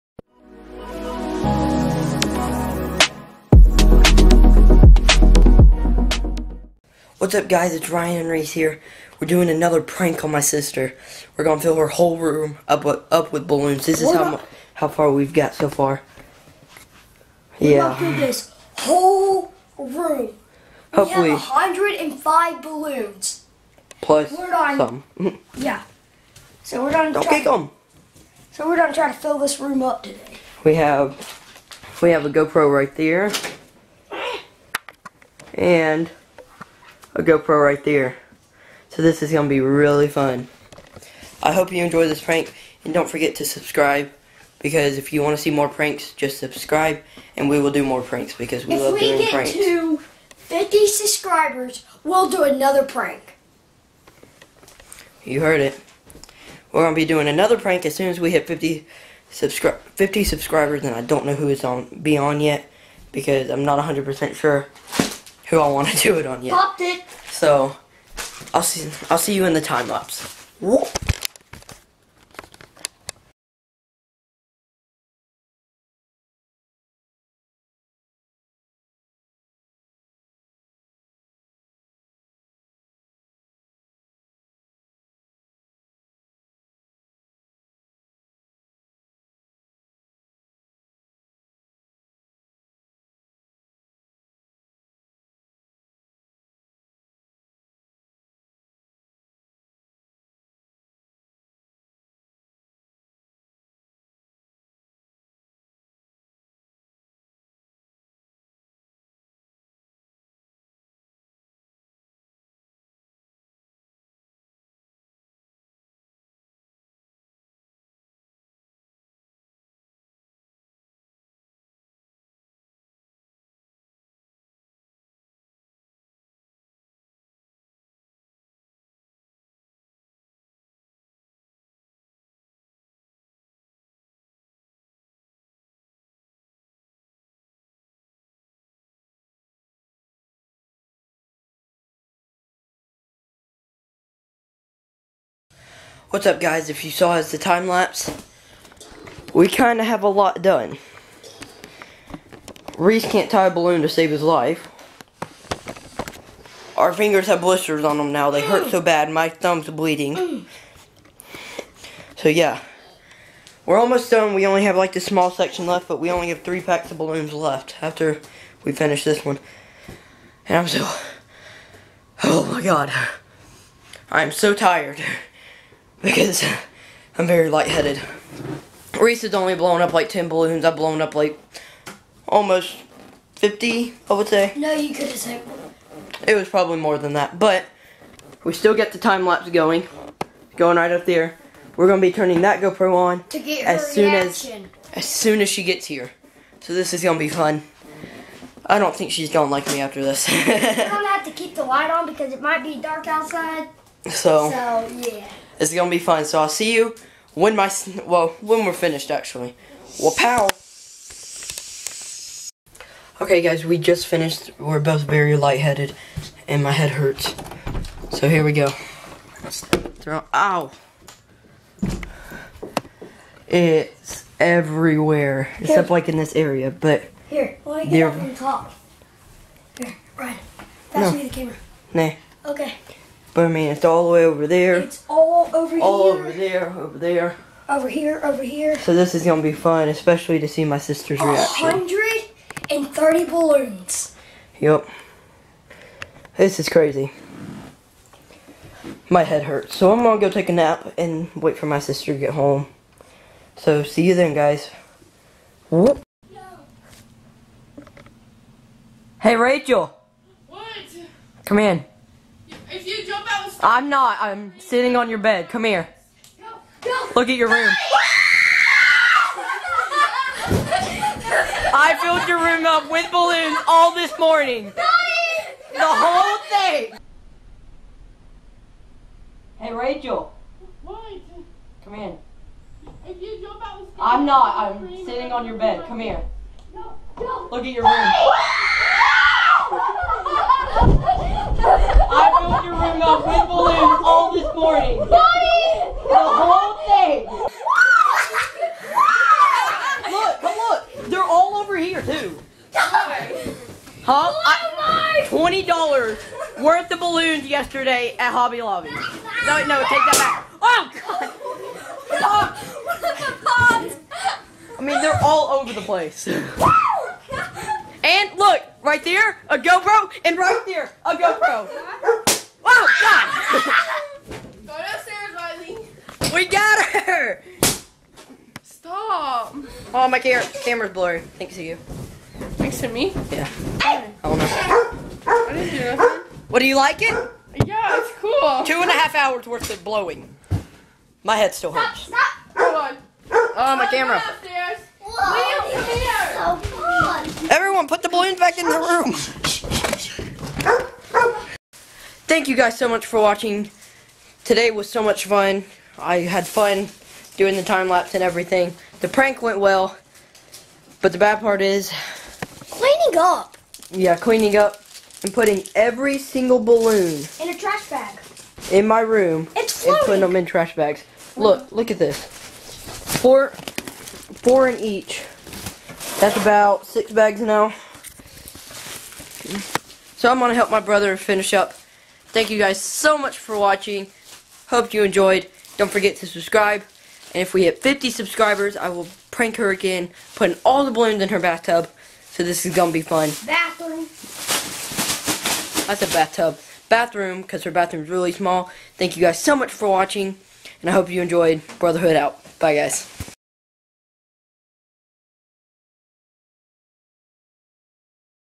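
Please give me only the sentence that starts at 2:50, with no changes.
And I'm so, oh my god, I'm so tired because I'm very lightheaded.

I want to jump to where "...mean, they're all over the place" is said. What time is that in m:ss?
5:14.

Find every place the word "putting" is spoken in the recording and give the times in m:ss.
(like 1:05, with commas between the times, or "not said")
6:05, 6:10, 6:30.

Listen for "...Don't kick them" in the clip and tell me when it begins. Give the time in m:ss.
0:27.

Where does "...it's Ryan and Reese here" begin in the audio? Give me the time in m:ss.
0:07.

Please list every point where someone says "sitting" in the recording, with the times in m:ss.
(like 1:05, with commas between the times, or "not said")
4:24, 4:45.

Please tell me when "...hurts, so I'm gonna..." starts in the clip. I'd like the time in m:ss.
4:09.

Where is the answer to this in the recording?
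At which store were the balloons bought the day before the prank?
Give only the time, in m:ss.
5:08.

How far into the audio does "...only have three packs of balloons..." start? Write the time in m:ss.
2:46.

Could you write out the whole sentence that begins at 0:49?
If we get to 50 subscribers, we'll do another prank.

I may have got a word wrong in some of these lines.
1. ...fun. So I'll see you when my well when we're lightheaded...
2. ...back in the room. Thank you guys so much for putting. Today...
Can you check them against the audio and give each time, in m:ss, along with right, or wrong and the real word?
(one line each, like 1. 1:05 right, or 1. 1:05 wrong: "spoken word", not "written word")
1. 3:25 wrong: "finished", not "lightheaded"
2. 5:48 wrong: "watching", not "putting".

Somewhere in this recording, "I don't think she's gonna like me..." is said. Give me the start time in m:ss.
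3:18.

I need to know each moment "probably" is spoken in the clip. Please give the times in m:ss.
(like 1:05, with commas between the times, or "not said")
3:06.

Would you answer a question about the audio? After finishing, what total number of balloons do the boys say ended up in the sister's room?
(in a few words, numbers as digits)
130.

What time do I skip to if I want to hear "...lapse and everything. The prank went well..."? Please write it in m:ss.
5:57.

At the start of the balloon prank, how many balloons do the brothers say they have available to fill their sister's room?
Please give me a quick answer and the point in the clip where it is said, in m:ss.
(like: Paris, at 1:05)
105, at 0:21.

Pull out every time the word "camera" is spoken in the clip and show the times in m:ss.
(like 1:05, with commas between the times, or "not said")
3:51, 5:30, 5:43.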